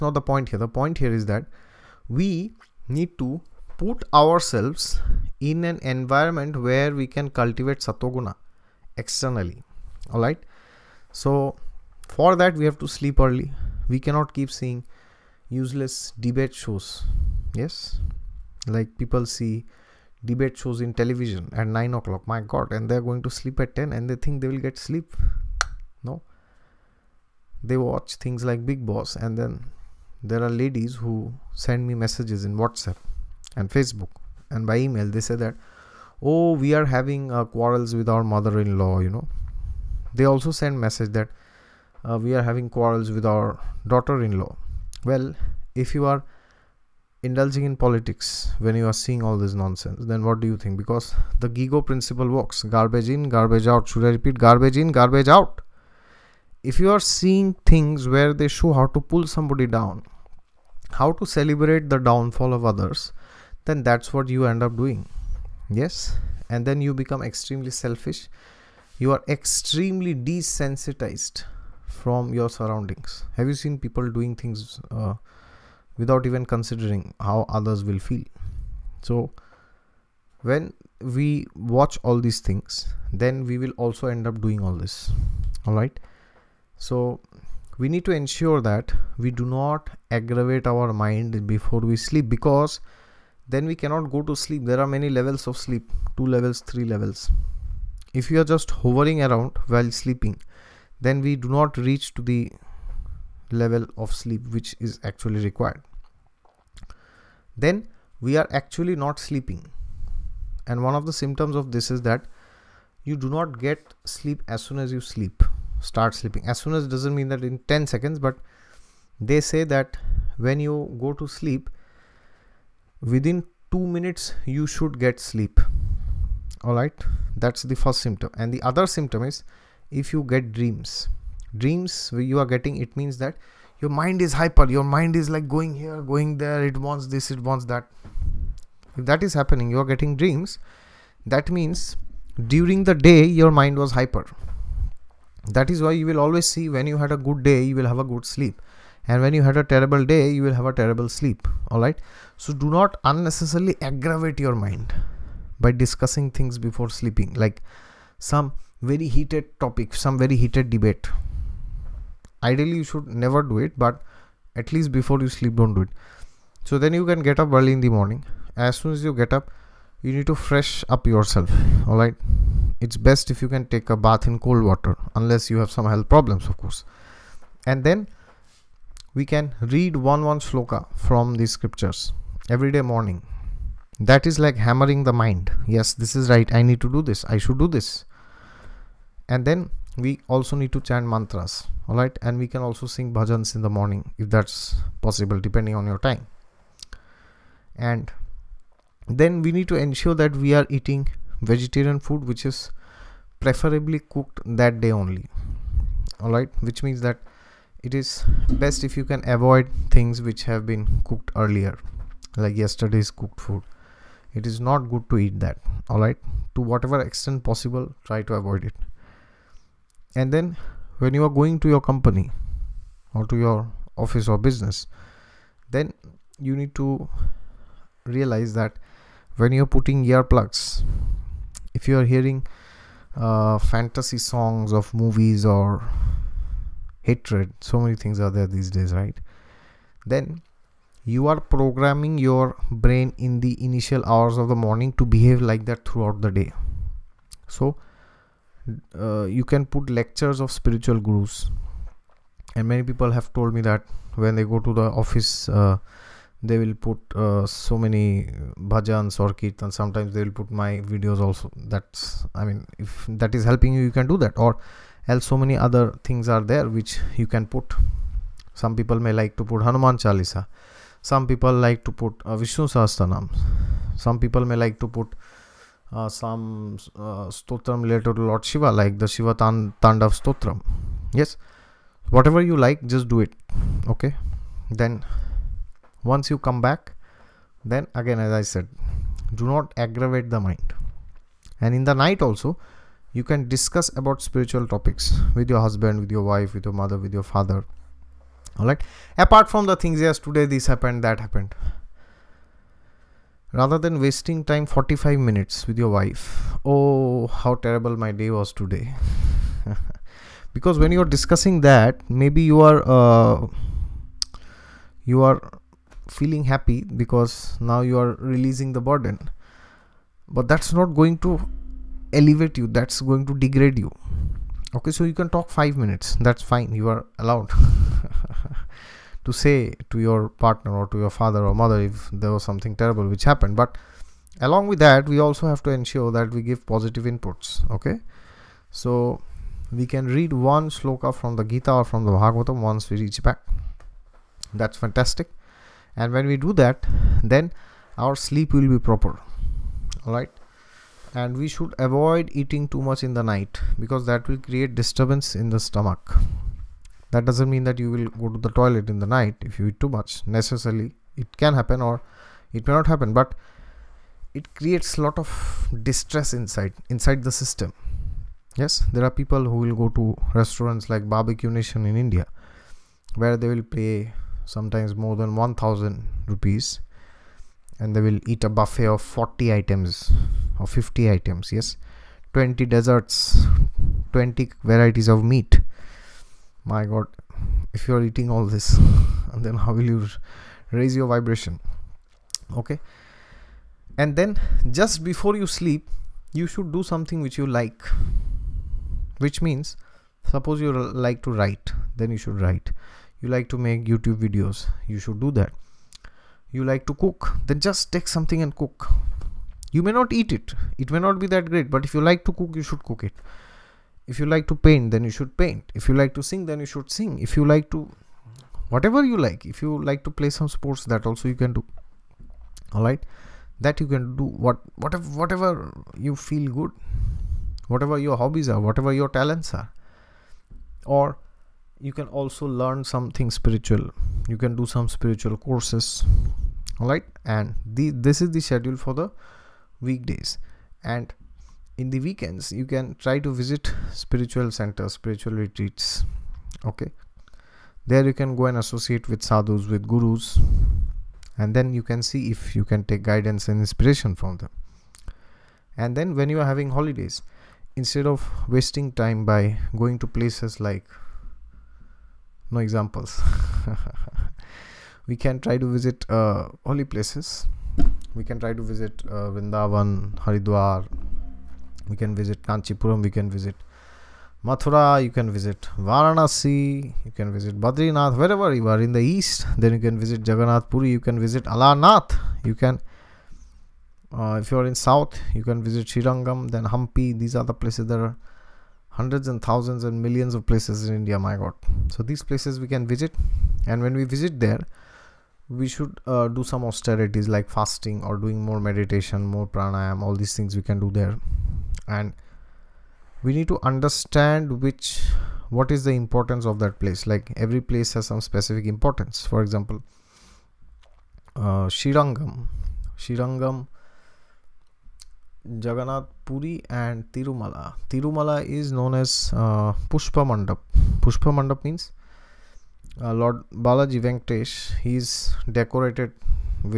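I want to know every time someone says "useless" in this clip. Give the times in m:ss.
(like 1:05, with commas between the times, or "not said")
0:15.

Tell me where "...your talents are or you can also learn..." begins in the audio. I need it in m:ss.
7:08.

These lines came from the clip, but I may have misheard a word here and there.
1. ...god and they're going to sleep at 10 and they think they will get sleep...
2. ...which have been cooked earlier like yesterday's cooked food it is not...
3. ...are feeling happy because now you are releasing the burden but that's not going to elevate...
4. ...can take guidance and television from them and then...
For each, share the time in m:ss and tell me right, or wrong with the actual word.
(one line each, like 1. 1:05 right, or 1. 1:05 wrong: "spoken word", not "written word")
1. 0:22 right
2. 3:30 right
3. 5:15 right
4. 7:32 wrong: "inspiration", not "television".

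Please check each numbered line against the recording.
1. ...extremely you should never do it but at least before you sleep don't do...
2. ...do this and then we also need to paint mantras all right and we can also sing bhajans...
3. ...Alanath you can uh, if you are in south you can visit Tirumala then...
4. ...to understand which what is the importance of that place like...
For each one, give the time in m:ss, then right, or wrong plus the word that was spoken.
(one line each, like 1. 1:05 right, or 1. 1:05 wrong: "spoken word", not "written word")
1. 2:42 wrong: "ideally", not "extremely"
2. 3:07 wrong: "chant", not "paint"
3. 8:01 wrong: "Srirangam", not "Tirumala"
4. 8:23 right.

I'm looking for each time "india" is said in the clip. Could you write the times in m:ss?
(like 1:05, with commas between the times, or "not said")
6:12, 8:10.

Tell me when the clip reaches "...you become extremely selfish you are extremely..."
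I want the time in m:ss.
1:06.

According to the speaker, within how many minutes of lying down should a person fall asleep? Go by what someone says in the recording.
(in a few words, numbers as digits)
2 minutes.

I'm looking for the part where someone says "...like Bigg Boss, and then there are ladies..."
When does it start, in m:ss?
0:28.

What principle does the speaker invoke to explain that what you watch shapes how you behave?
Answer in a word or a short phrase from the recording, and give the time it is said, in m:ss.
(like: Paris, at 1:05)
GIGO principle, at 0:51.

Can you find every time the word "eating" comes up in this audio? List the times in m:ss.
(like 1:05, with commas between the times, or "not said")
3:20, 5:52, 6:28.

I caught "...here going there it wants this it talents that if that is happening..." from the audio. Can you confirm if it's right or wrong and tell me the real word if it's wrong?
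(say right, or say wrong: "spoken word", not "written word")
wrong: "wants", not "talents".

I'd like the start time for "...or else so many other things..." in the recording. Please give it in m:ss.
4:24.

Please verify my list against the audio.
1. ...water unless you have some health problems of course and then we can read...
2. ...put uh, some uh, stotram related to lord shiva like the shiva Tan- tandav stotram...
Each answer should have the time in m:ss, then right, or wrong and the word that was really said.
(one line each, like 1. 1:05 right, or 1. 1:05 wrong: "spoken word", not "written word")
1. 2:54 right
2. 4:34 right.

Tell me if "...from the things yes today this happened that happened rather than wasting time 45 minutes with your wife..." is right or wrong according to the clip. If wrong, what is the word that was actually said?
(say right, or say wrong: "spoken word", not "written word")
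right.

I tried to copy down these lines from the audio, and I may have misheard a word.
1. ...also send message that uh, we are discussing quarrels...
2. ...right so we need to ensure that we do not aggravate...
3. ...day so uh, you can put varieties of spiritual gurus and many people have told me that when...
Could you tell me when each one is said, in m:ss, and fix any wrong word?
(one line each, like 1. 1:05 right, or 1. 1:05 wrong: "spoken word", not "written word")
1. 0:40 wrong: "having", not "discussing"
2. 1:25 right
3. 4:06 wrong: "lectures", not "varieties".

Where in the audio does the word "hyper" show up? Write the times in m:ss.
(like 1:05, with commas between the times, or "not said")
2:14, 2:23.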